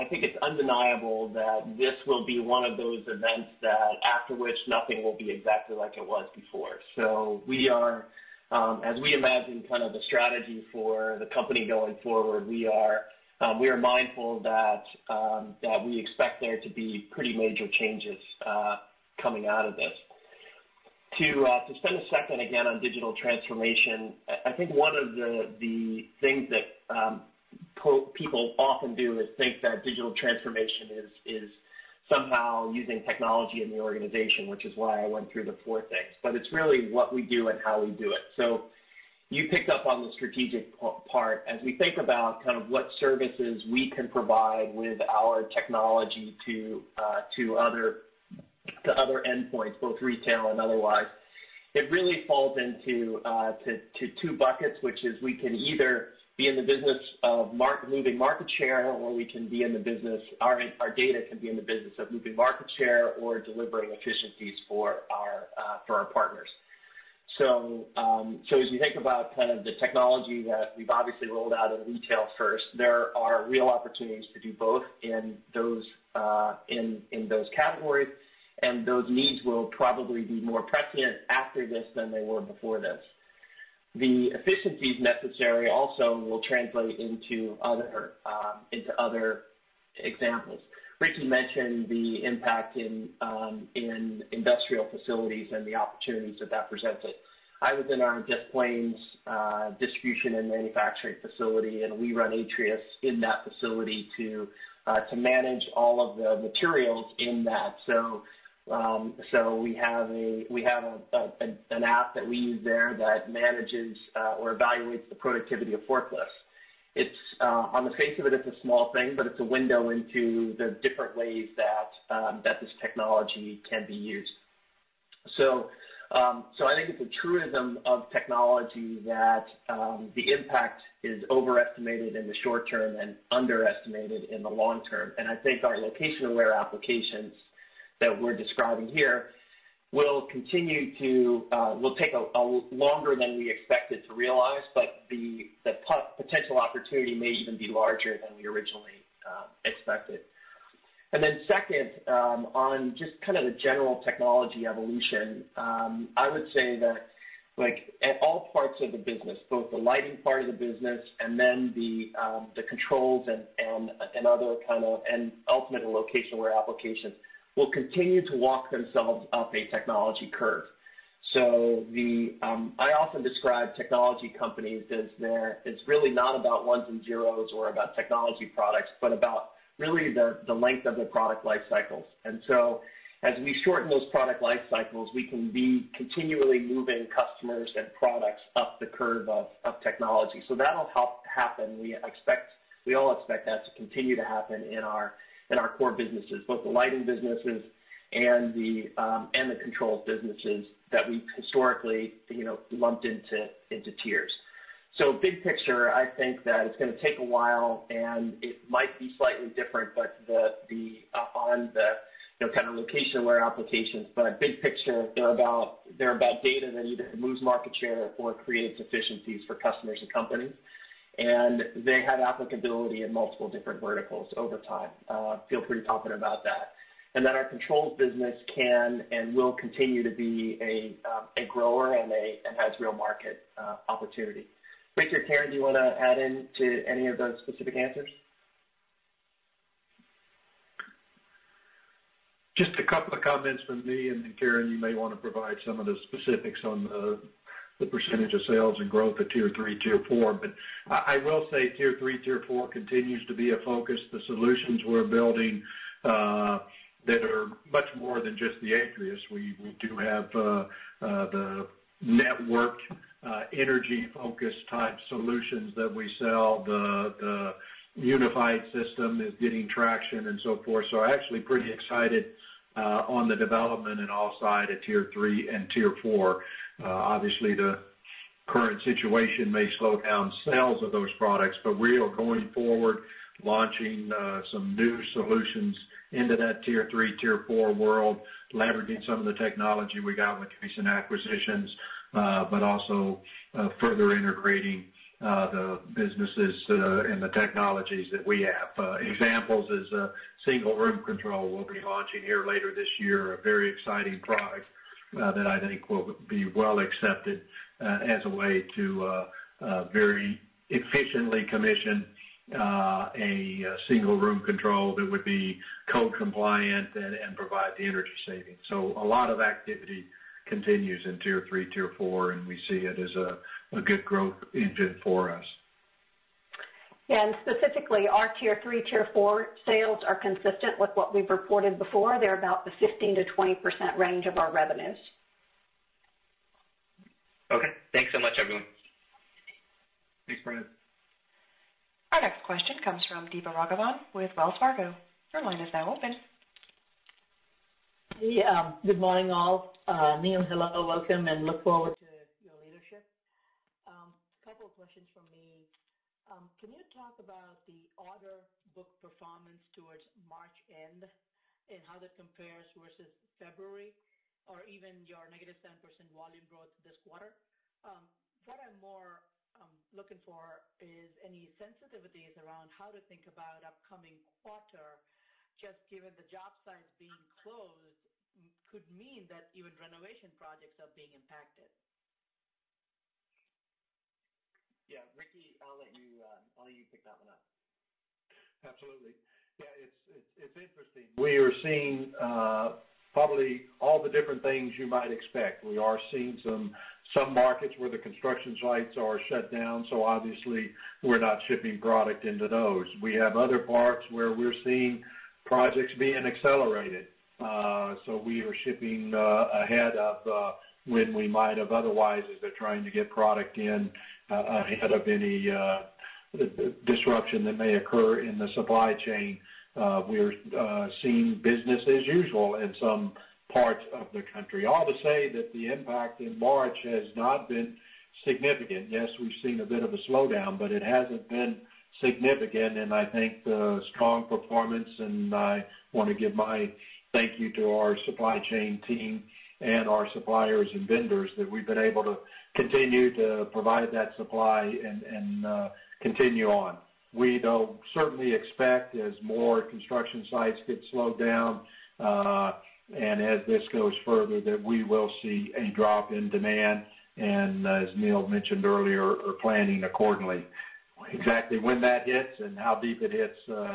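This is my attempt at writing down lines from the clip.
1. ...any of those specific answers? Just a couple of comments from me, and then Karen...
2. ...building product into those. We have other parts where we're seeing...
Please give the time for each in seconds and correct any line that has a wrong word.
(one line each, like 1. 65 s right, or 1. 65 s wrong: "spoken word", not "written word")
1. 236 s right
2. 401 s wrong: "shipping", not "building".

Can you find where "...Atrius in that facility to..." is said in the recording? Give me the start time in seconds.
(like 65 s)
102 s.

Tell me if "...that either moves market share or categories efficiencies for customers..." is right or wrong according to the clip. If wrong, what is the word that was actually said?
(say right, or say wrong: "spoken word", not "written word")
wrong: "creates", not "categories".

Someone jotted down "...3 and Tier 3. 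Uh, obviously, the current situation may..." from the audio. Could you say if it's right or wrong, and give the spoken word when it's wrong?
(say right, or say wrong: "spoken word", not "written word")
wrong: "4", not "3".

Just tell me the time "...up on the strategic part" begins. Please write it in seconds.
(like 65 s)
39 s.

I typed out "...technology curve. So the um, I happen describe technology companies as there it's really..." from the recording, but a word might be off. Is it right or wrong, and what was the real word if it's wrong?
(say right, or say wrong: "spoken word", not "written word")
wrong: "often", not "happen".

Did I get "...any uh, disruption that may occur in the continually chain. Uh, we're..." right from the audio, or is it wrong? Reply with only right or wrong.
wrong.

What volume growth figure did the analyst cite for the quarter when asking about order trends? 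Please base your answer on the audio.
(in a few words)
-7%.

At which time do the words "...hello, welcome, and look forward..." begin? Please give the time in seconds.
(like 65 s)
350 s.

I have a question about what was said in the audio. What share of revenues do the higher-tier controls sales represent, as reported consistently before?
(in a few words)
15%-20%.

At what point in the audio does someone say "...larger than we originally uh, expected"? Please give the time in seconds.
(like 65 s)
147 s.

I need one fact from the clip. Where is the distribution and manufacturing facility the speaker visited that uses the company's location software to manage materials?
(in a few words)
Des Plaines.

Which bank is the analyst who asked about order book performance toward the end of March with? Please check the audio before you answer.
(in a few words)
Wells Fargo.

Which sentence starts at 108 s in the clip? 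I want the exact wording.
Um, so We have an app that we use there that manages uh, or evaluates the productivity of forklifts.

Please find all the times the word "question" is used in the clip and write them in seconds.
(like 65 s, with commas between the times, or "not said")
342 s, 354 s.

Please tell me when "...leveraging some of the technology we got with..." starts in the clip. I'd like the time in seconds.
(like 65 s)
288 s.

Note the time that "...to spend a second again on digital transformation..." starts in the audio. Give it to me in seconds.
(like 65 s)
21 s.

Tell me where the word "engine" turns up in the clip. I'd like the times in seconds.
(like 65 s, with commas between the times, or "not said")
324 s.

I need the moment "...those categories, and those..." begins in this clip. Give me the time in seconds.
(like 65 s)
77 s.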